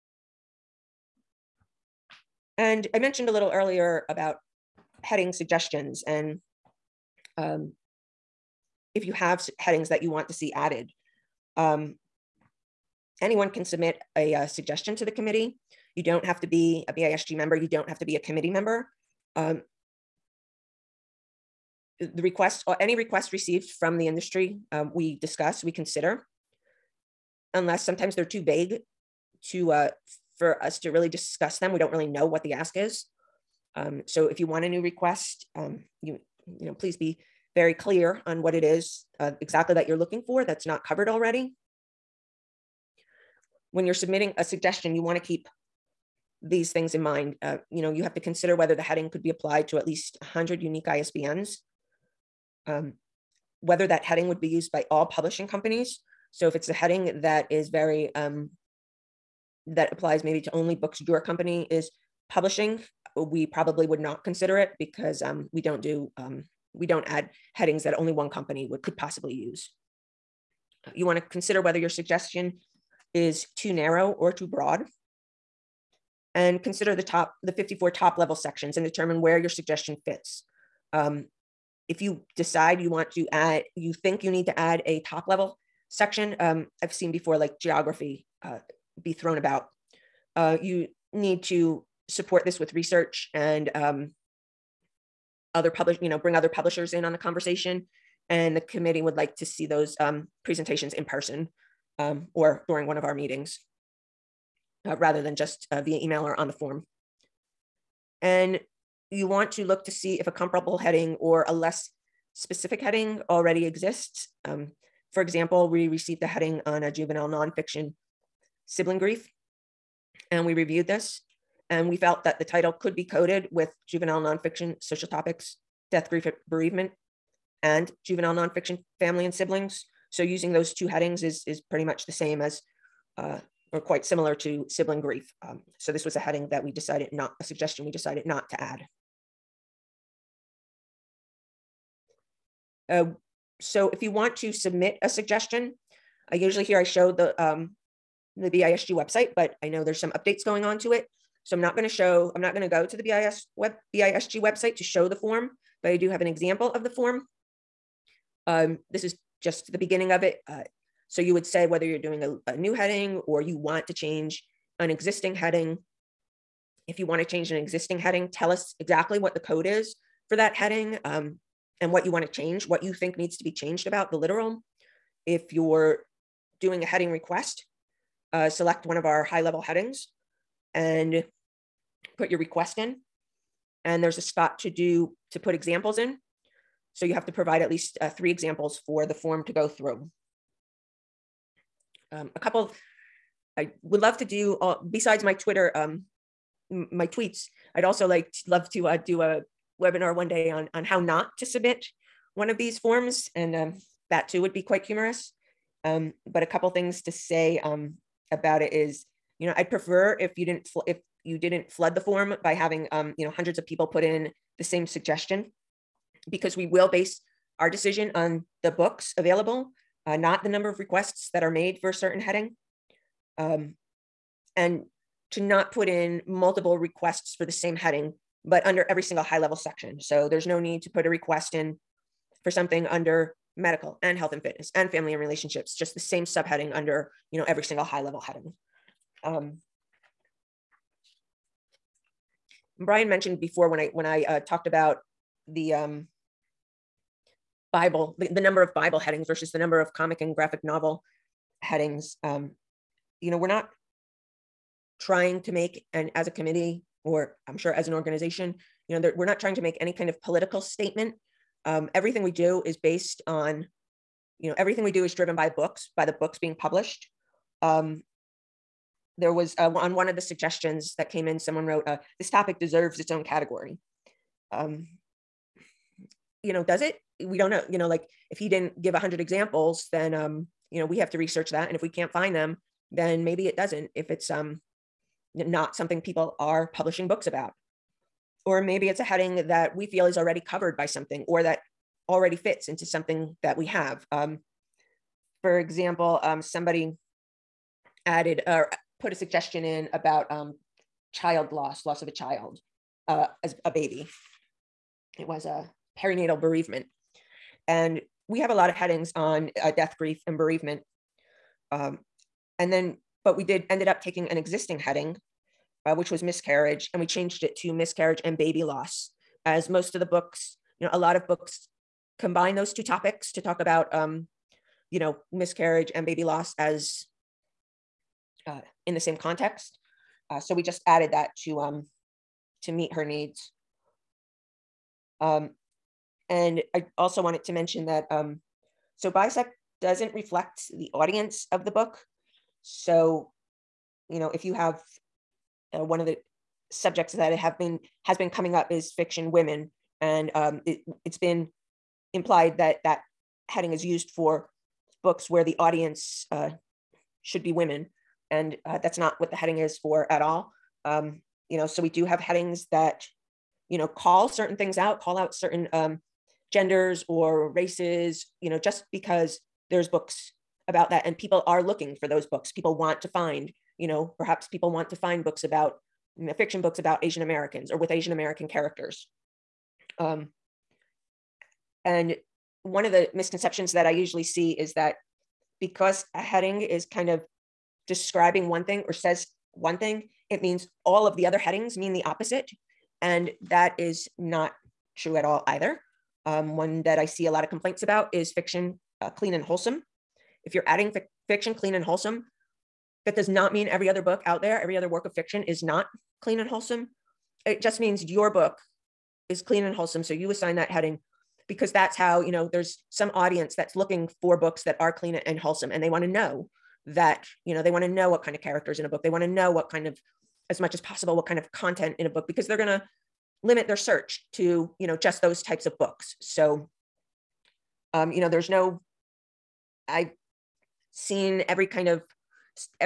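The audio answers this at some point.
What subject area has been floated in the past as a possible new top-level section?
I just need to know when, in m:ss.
1:27.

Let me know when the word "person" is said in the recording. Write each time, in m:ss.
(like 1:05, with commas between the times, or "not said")
1:41.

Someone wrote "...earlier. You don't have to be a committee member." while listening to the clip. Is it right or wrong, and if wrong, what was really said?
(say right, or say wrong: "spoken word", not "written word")
wrong: "member", not "earlier".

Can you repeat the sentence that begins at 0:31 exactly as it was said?
We don't really know what the ask is.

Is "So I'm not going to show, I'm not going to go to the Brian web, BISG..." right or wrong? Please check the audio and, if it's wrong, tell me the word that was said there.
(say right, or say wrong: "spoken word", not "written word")
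wrong: "BIS", not "Brian".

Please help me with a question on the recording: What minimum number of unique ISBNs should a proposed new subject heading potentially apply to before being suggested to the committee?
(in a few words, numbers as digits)
100.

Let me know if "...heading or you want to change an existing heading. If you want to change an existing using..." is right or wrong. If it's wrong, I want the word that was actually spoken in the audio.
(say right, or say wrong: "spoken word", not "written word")
wrong: "heading", not "using".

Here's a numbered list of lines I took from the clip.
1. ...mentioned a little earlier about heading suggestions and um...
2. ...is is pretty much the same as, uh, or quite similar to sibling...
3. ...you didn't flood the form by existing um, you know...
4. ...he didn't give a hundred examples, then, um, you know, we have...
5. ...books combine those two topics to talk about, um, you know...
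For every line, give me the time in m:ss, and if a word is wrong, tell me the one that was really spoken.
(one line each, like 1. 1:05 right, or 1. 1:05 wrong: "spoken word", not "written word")
1. 0:02 right
2. 2:11 right
3. 3:31 wrong: "having", not "existing"
4. 4:38 right
5. 5:21 right.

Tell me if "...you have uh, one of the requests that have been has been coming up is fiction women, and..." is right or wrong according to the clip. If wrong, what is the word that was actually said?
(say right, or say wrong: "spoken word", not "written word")
wrong: "subjects", not "requests".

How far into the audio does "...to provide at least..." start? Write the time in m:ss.
3:07.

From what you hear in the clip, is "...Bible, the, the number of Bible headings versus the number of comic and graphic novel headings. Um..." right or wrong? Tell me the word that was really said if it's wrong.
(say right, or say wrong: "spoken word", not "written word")
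right.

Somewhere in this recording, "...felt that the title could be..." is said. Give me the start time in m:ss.
2:01.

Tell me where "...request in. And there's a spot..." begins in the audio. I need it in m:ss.
3:02.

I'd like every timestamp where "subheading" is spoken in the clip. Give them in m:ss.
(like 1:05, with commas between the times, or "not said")
3:56.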